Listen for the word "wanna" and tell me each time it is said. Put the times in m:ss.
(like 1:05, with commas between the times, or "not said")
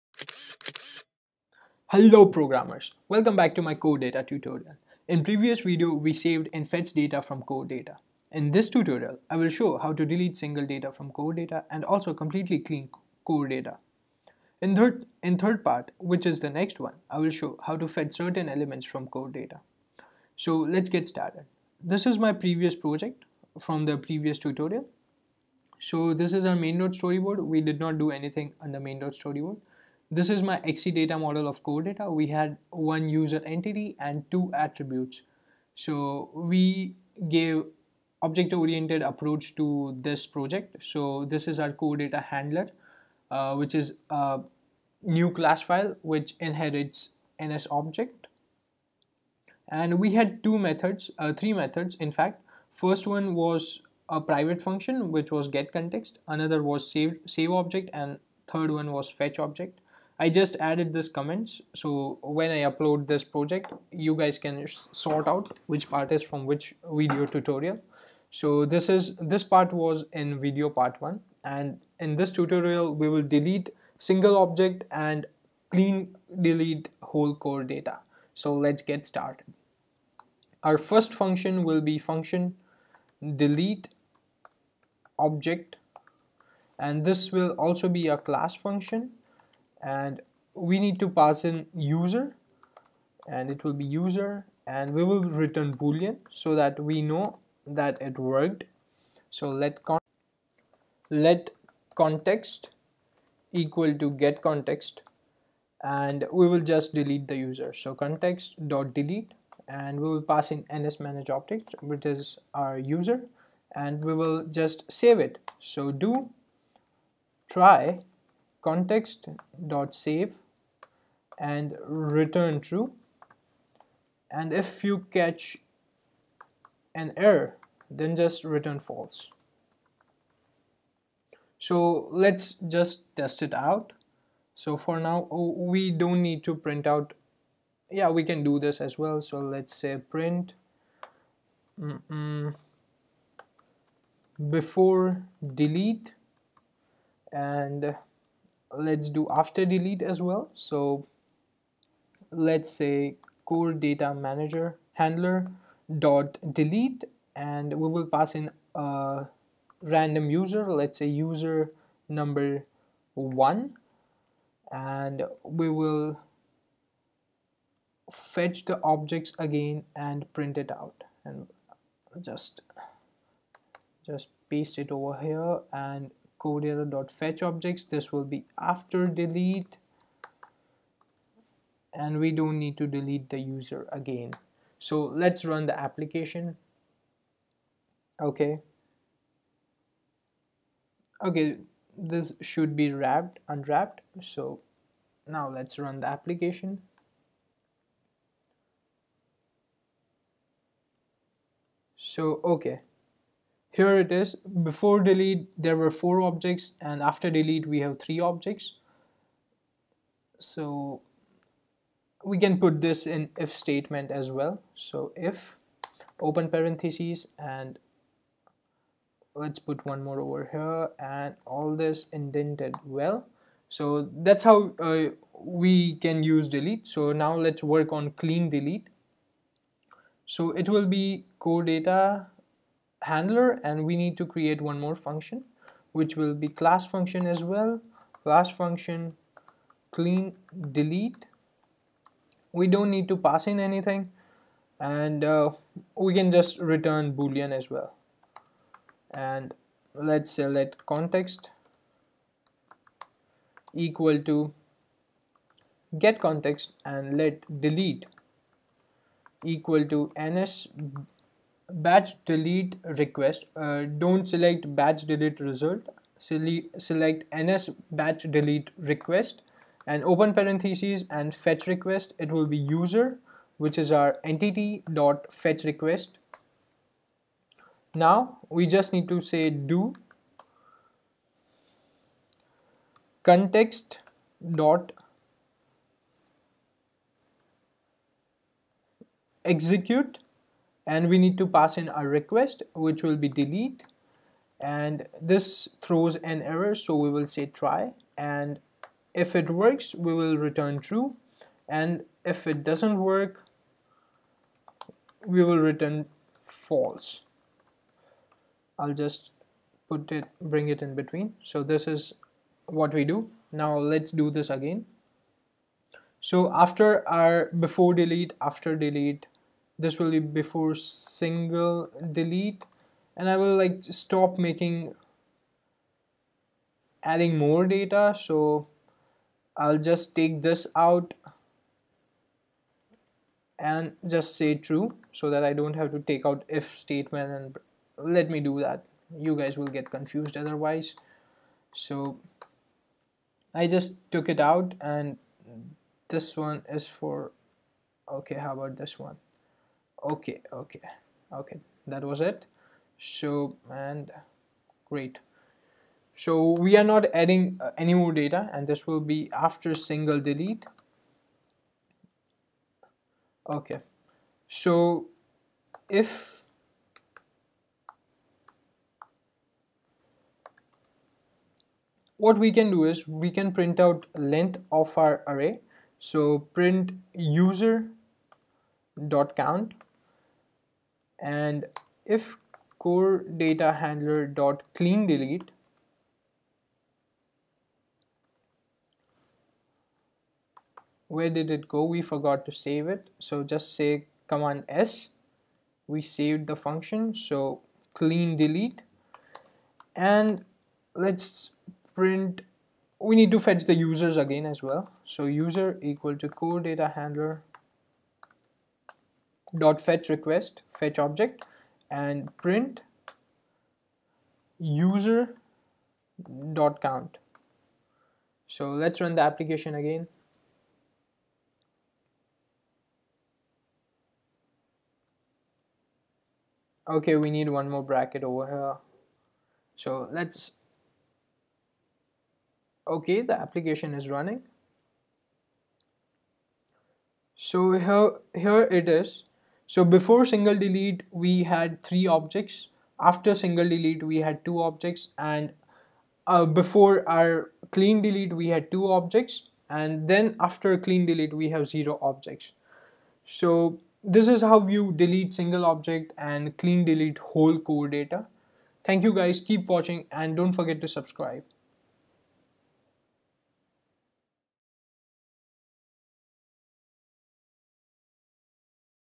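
not said.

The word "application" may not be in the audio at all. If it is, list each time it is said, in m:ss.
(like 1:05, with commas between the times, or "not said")
3:05, 3:16, 6:59, 7:13.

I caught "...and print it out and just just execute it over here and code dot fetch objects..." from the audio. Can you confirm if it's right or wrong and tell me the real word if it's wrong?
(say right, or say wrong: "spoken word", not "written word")
wrong: "paste", not "execute".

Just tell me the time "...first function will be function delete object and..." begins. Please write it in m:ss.
1:20.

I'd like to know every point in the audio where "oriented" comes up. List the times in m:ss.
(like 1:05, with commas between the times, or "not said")
0:38.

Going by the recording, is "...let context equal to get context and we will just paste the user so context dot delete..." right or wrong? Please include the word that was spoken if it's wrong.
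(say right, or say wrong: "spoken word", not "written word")
wrong: "delete", not "paste".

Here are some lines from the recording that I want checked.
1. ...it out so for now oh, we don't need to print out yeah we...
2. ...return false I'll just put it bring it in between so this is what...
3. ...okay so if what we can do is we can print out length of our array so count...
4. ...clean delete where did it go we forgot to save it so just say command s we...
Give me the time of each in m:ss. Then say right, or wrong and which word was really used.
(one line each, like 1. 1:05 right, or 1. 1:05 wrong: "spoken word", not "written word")
1. 2:13 right
2. 5:05 right
3. 6:03 wrong: "print", not "count"
4. 6:24 right.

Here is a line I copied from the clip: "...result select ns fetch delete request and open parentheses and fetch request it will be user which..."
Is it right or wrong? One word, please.
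wrong.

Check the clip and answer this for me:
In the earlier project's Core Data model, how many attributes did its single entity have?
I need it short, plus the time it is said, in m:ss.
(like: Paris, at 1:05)
2, at 0:34.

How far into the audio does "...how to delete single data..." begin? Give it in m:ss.
0:09.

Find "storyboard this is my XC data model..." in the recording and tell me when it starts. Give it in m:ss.
0:29.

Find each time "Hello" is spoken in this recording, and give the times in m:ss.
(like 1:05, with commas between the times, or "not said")
0:01.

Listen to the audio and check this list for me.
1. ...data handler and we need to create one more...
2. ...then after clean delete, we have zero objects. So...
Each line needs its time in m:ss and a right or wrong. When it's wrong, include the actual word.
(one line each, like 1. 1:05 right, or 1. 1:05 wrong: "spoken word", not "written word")
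1. 3:51 right
2. 7:30 right.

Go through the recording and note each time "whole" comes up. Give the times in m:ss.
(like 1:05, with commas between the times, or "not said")
1:17, 7:37.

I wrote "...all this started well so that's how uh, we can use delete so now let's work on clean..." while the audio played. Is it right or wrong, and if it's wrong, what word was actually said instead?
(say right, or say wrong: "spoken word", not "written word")
wrong: "indented", not "started".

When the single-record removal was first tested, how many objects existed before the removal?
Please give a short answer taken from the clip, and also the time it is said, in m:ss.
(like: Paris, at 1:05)
4, at 3:25.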